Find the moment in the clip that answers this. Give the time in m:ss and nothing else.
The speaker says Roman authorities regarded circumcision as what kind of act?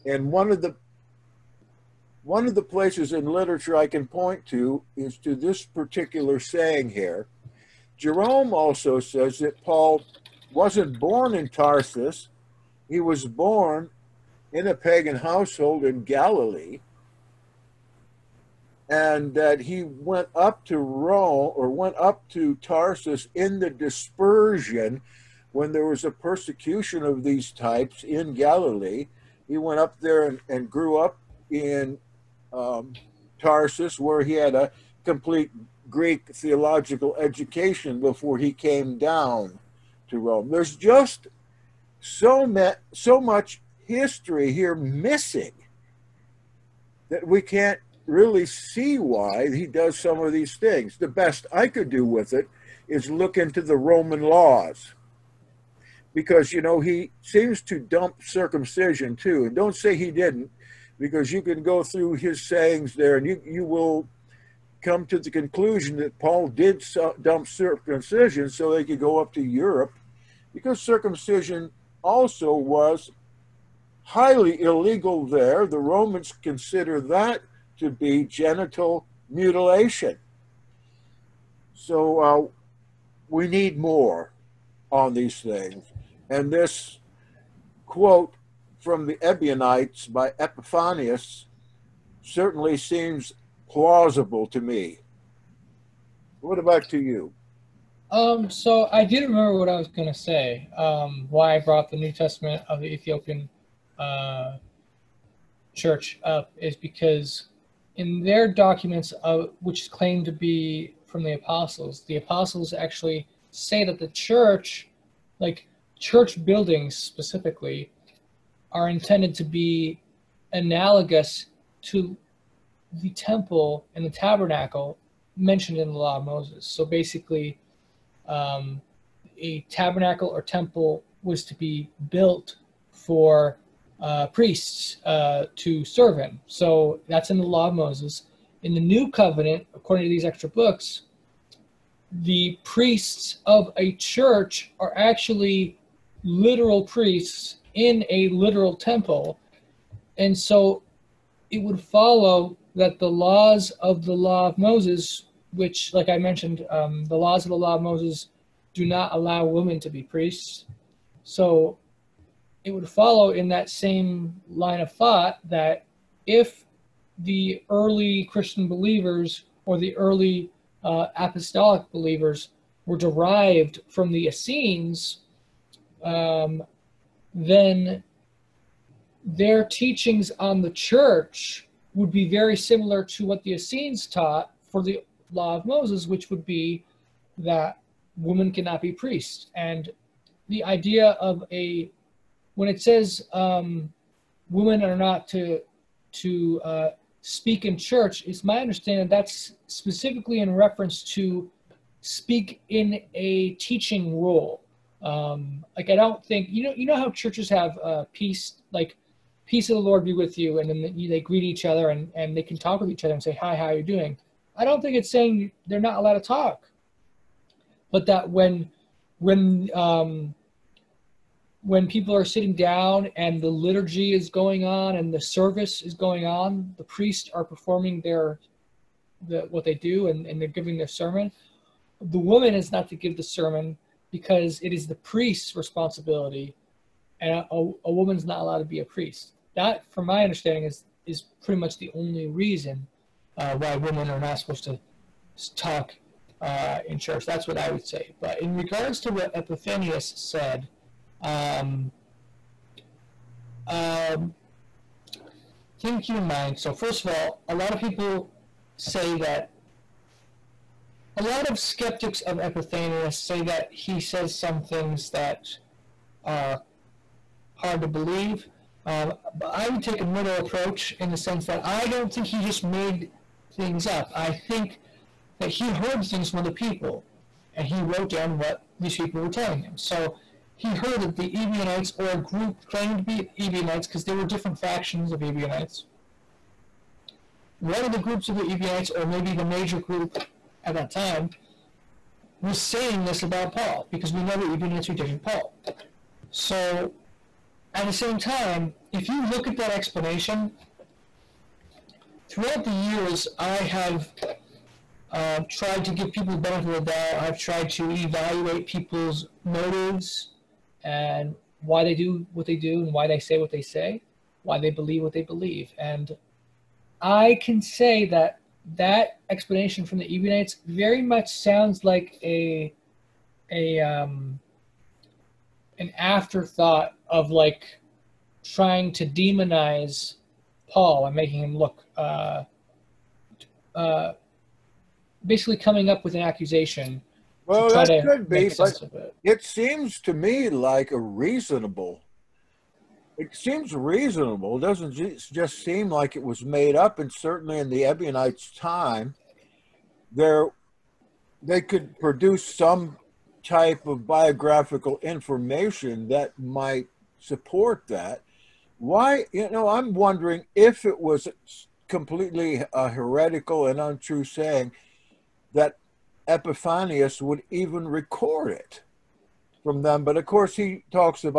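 1:18.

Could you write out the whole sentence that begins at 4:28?
Um, I would take a middle approach in the sense that I don't think he just made things up.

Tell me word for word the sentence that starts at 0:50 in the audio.
The best I could do with it is look into the Roman laws because, you know, he seems to dump circumcision too.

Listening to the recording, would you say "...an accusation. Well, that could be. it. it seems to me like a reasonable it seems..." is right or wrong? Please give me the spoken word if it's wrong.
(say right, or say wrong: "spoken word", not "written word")
right.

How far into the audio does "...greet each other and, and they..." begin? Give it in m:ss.
3:31.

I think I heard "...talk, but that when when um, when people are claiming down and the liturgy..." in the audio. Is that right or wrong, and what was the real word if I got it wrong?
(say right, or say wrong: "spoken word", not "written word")
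wrong: "sitting", not "claiming".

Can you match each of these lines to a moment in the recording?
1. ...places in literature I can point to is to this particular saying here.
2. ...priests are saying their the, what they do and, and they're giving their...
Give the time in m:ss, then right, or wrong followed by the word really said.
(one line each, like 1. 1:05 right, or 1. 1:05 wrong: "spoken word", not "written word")
1. 0:02 right
2. 3:46 wrong: "performing", not "saying".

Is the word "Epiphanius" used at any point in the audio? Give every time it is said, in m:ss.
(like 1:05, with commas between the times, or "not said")
1:30, 4:09, 4:22, 6:06.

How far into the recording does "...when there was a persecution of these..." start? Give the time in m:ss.
0:25.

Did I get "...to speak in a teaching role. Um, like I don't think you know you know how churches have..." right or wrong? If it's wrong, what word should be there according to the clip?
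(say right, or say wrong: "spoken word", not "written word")
right.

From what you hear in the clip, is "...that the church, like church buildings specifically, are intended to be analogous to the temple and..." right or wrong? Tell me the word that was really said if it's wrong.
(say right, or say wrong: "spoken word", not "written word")
right.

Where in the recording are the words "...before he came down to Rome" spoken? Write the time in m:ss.
0:37.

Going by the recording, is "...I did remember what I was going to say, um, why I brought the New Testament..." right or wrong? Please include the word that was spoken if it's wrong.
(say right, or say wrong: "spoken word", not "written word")
right.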